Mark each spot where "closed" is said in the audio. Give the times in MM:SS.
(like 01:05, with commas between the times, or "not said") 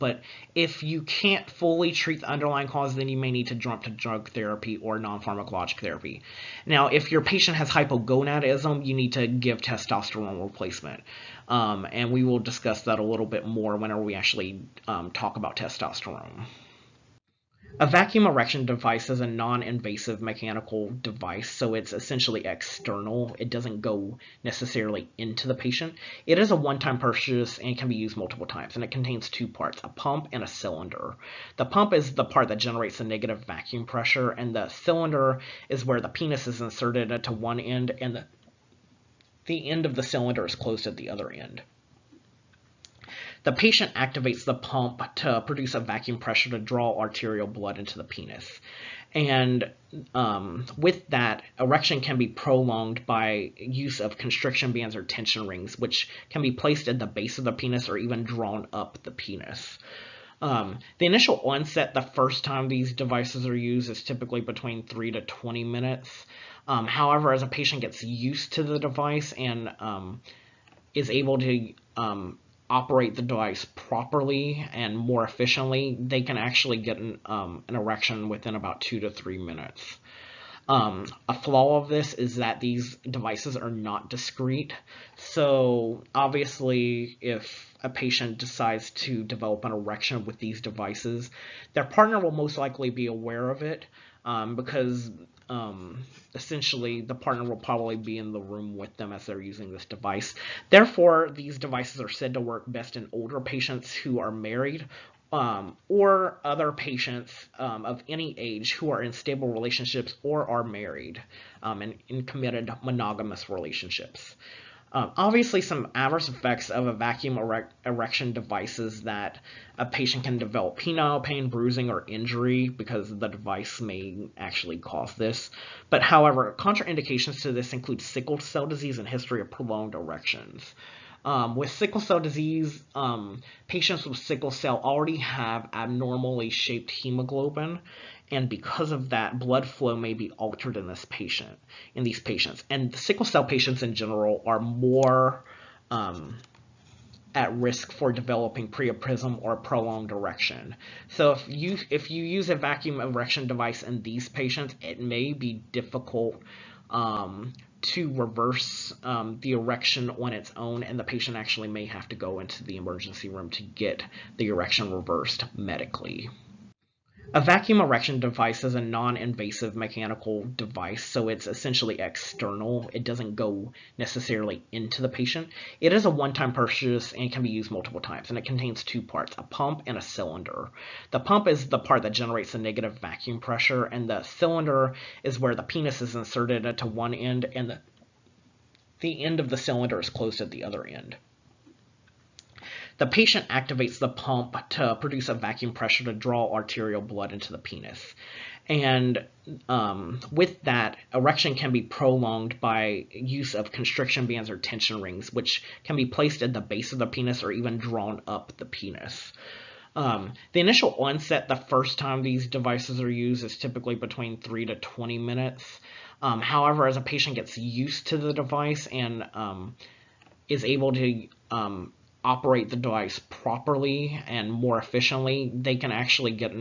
00:40, 03:10.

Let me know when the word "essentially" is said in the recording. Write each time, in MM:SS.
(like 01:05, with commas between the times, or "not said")
00:21, 01:36, 02:51.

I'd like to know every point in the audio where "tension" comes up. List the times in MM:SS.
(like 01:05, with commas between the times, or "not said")
00:55, 03:24.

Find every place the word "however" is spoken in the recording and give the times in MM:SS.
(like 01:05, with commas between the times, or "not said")
01:06, 02:06, 03:36.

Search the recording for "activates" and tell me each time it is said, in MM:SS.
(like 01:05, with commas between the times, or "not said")
00:43, 03:13.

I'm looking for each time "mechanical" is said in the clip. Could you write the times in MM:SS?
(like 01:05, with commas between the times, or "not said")
00:20, 02:49.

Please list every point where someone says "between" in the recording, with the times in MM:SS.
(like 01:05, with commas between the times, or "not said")
01:04, 03:33.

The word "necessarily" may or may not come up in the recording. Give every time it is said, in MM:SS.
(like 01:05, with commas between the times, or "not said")
00:24, 02:53.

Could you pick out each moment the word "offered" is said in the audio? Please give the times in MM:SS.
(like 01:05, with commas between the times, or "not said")
not said.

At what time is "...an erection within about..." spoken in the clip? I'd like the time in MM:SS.
01:17.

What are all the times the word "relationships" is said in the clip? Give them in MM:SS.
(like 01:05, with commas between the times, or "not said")
01:49, 01:53.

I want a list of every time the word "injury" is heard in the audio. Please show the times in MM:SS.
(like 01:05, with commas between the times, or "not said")
02:02.